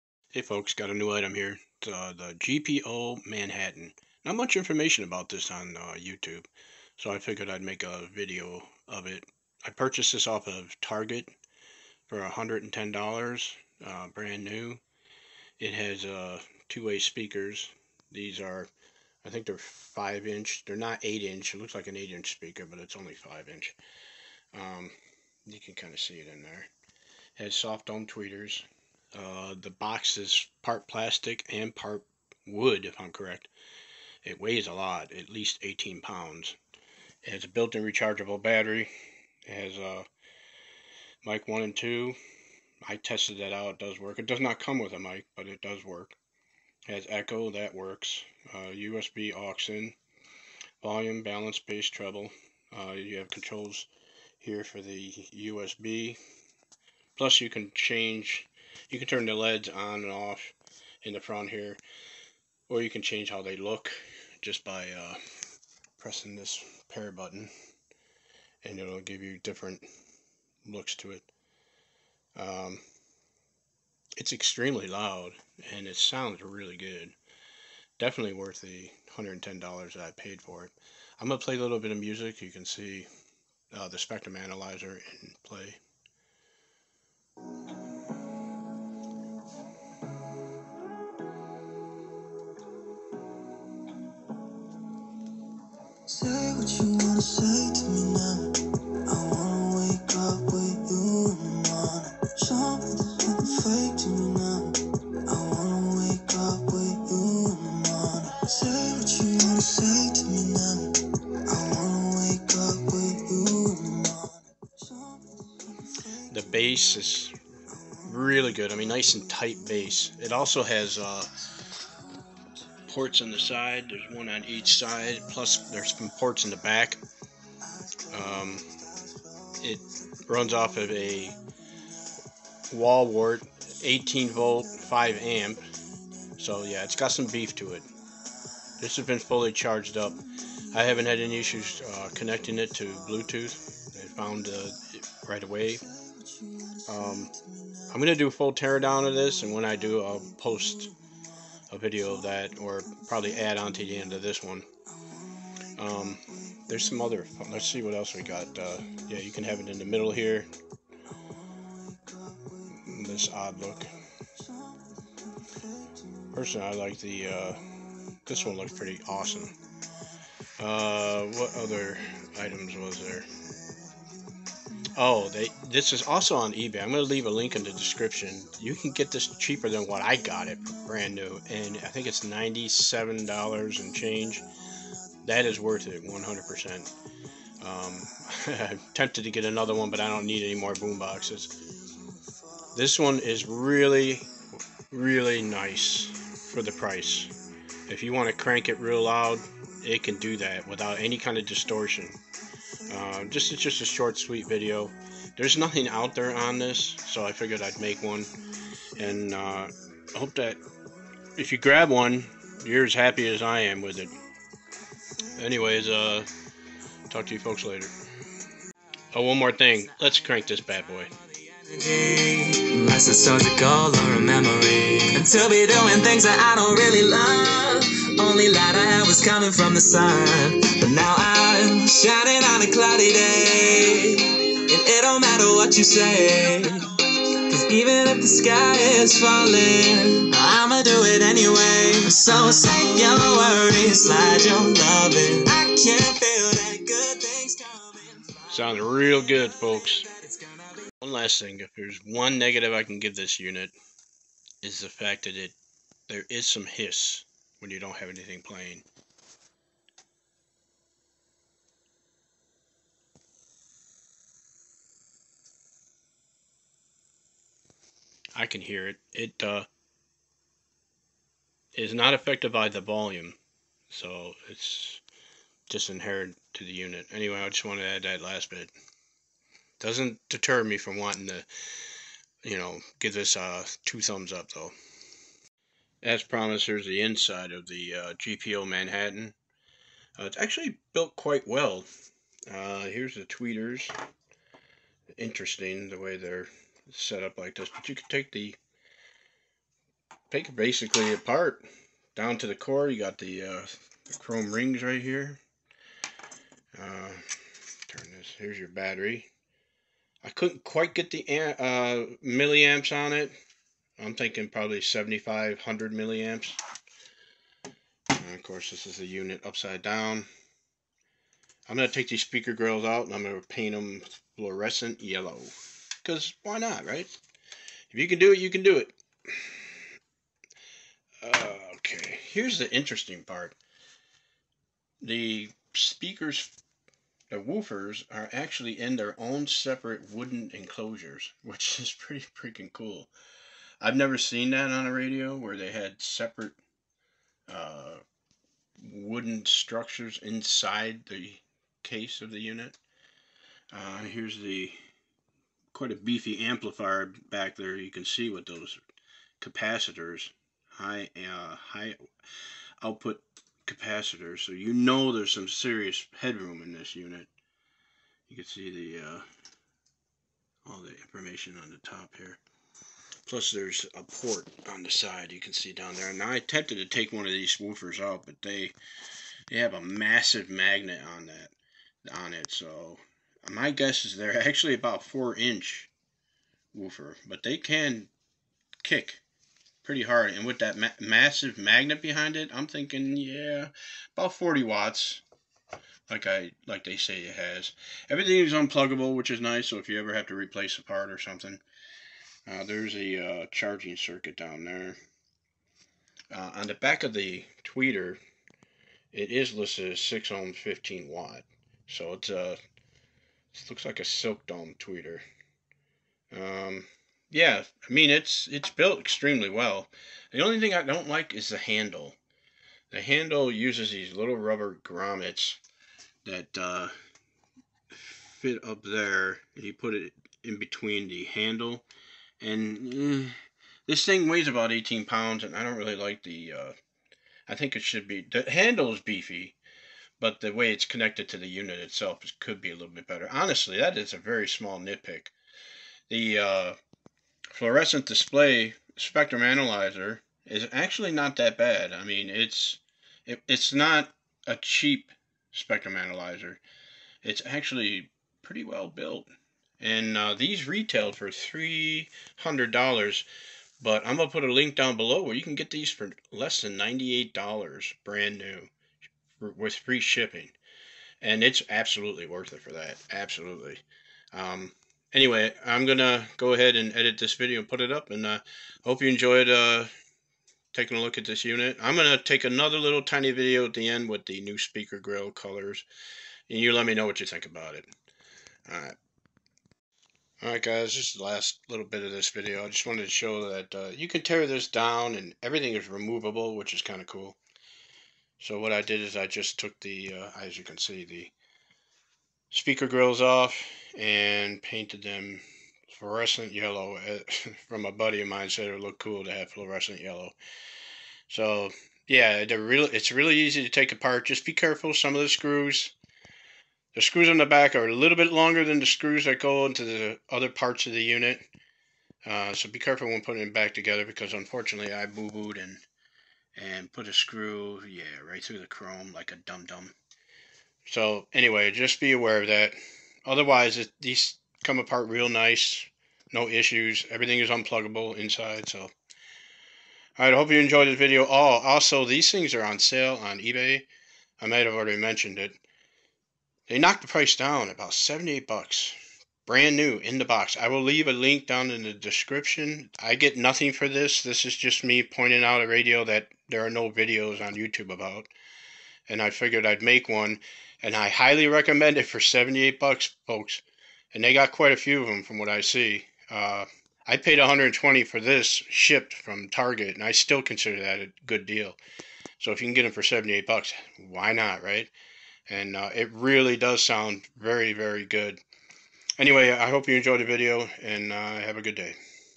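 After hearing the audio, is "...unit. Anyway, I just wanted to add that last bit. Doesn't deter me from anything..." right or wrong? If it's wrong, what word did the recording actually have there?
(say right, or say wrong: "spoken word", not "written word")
wrong: "wanting", not "anything".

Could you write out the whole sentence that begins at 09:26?
Uh, I paid 120 for this shipped from Target, and I still consider that a good deal.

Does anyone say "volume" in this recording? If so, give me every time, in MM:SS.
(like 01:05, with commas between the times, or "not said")
00:50, 04:32.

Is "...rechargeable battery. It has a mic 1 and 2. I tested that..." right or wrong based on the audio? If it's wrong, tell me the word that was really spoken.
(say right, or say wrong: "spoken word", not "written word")
right.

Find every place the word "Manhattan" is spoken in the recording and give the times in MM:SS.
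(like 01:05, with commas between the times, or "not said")
00:03, 04:48.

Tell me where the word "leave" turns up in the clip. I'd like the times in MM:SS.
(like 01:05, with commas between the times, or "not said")
02:57, 09:10.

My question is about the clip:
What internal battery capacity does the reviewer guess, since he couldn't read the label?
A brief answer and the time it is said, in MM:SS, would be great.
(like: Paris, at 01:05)
7500 milliamps, at 05:14.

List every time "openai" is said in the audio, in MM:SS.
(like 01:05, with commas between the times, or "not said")
not said.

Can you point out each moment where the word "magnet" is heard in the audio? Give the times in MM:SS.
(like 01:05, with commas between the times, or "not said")
06:20, 06:31.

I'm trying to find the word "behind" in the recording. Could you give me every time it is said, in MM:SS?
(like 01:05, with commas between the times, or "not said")
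06:32.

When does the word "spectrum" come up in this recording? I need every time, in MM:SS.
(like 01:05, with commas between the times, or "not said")
01:23, 07:28, 07:35.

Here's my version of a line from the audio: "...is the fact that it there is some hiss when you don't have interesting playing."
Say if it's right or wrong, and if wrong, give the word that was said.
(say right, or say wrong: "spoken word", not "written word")
wrong: "anything", not "interesting".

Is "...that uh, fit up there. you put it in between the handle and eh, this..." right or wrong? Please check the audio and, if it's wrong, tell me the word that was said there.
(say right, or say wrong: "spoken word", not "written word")
right.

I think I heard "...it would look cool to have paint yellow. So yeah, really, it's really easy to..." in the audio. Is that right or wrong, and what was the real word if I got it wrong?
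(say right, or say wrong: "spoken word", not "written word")
wrong: "fluorescent", not "paint".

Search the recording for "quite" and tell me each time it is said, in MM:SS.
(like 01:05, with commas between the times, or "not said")
04:51, 05:10, 05:55, 09:24.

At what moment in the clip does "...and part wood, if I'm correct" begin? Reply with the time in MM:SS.
00:31.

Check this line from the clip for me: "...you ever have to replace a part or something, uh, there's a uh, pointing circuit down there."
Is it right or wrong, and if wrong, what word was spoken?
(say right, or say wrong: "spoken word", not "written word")
wrong: "charging", not "pointing".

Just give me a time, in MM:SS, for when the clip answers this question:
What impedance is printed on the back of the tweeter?
06:50.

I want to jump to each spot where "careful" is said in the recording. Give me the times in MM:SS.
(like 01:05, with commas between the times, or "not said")
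08:34, 08:42.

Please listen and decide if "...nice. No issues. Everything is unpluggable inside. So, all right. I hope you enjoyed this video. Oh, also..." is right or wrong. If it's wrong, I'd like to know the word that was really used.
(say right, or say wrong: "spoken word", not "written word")
right.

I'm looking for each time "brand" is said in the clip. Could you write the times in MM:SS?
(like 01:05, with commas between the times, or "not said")
00:14, 03:00, 07:48, 09:09.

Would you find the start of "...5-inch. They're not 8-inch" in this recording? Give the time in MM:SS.
00:19.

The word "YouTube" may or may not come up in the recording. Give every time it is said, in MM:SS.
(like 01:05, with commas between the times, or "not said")
00:05, 09:17.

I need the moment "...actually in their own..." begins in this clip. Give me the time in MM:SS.
05:38.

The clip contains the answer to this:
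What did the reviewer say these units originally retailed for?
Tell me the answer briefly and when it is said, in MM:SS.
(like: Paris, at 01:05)
$300, at 07:41.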